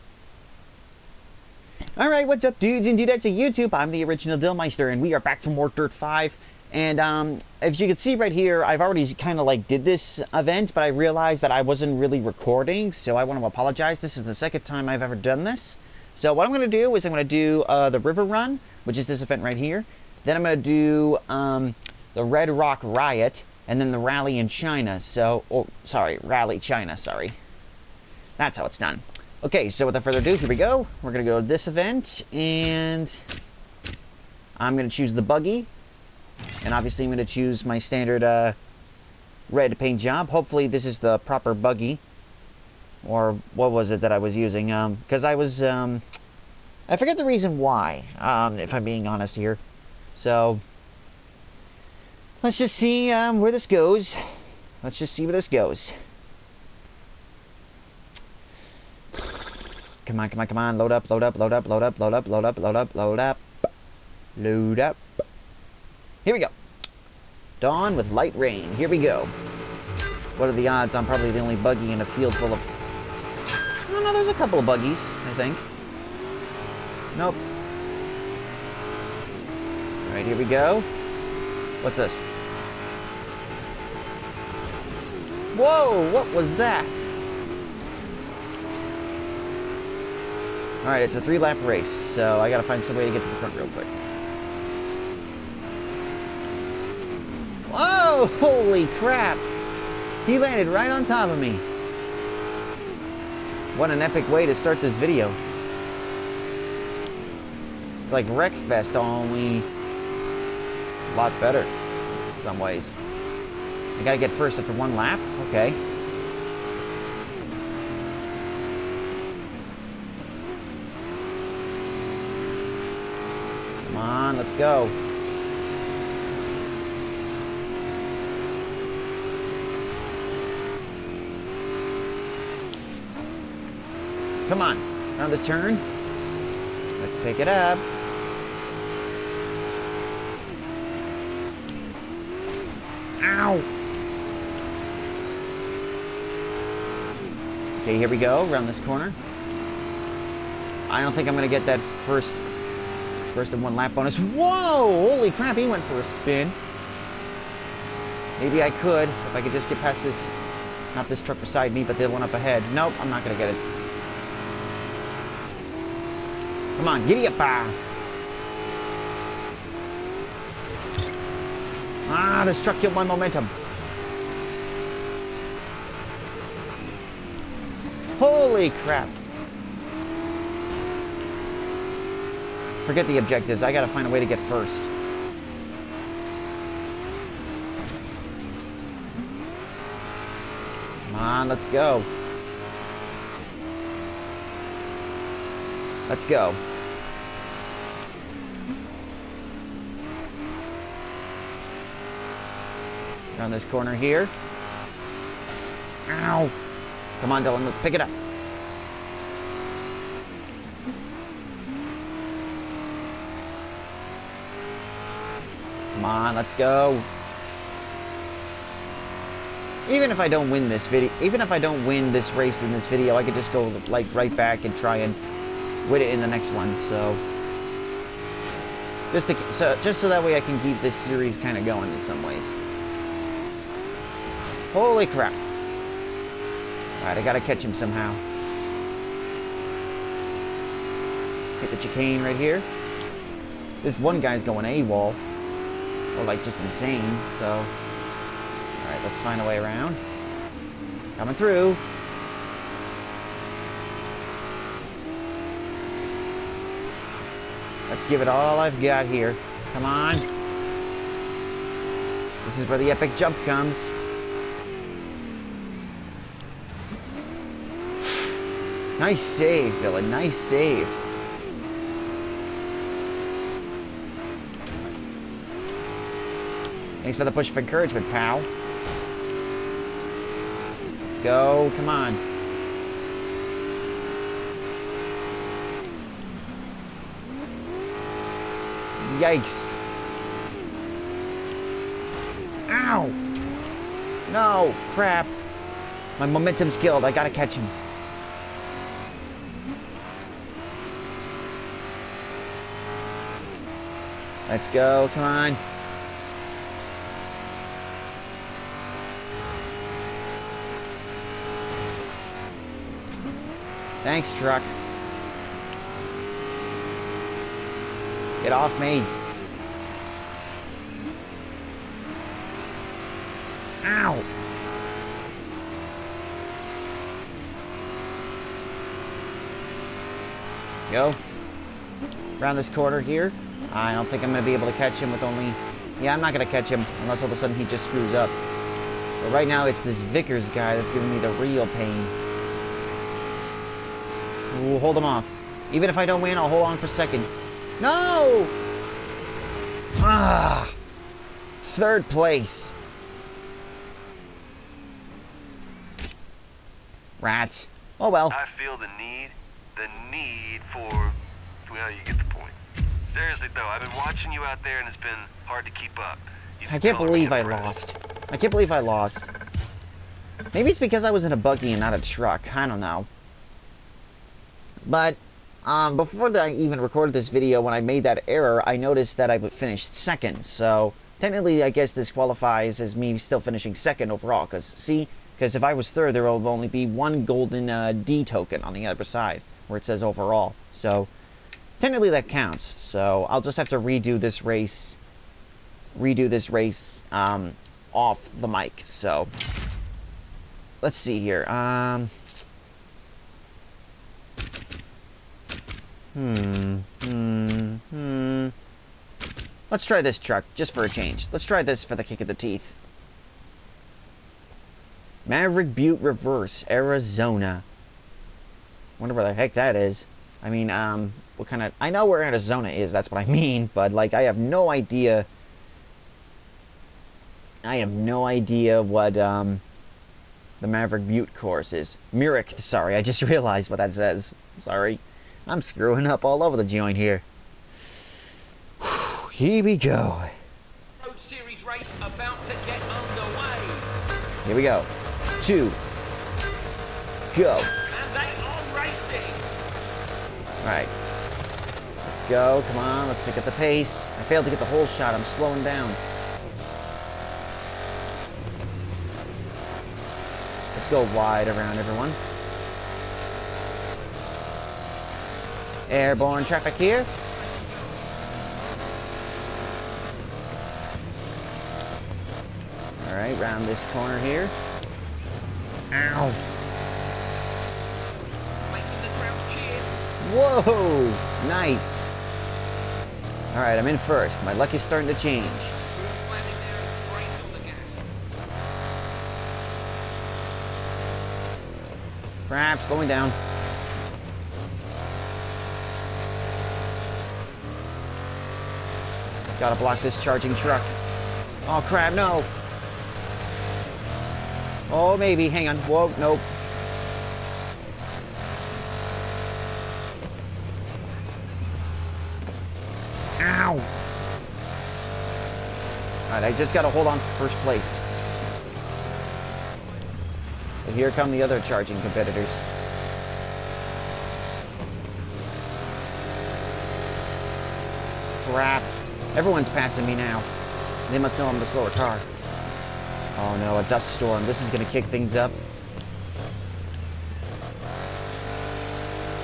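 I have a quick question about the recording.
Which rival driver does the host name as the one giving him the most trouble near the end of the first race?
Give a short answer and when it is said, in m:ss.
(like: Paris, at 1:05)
Vickers, at 5:39.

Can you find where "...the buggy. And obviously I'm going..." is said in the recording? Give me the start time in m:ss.
0:35.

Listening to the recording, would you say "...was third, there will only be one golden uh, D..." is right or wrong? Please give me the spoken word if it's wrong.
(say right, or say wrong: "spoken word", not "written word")
right.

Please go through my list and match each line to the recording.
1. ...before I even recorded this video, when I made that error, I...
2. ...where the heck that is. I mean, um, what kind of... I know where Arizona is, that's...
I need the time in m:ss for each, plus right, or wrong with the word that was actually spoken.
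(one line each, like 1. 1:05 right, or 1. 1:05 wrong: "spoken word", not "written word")
1. 6:15 right
2. 6:59 right.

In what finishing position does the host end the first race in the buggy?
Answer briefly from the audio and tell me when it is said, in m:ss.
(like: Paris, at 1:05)
Third place, at 5:51.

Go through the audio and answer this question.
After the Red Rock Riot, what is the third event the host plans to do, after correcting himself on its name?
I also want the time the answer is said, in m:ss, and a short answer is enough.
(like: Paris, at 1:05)
Rally China, at 0:26.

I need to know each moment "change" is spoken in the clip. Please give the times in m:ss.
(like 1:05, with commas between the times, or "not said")
6:50, 8:05.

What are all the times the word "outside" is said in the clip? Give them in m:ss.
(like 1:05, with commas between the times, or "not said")
not said.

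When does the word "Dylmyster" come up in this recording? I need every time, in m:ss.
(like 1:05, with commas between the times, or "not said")
0:04.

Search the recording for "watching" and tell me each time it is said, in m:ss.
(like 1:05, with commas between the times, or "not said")
6:03.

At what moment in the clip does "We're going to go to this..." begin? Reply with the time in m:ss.
0:31.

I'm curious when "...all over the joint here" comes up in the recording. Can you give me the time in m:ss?
7:16.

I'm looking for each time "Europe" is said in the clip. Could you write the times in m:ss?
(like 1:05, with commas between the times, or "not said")
not said.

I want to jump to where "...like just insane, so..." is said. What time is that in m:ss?
4:06.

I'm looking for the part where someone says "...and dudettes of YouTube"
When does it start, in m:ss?
0:02.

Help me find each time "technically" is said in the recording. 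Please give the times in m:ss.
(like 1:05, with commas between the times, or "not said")
6:21, 6:31.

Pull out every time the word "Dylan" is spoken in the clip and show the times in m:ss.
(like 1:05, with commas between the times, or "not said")
3:27, 4:29.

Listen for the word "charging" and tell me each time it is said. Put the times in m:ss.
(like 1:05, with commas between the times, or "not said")
8:20, 8:41.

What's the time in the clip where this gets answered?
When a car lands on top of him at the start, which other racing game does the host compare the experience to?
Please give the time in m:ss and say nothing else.
1:48.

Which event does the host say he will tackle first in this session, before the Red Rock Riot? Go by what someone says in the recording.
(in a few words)
River Run.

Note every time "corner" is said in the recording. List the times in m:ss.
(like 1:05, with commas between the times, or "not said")
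2:28, 3:23, 5:32, 7:53.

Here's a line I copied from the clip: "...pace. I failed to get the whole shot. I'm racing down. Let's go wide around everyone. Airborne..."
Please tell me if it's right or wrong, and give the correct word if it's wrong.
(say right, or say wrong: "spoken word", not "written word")
wrong: "slowing", not "racing".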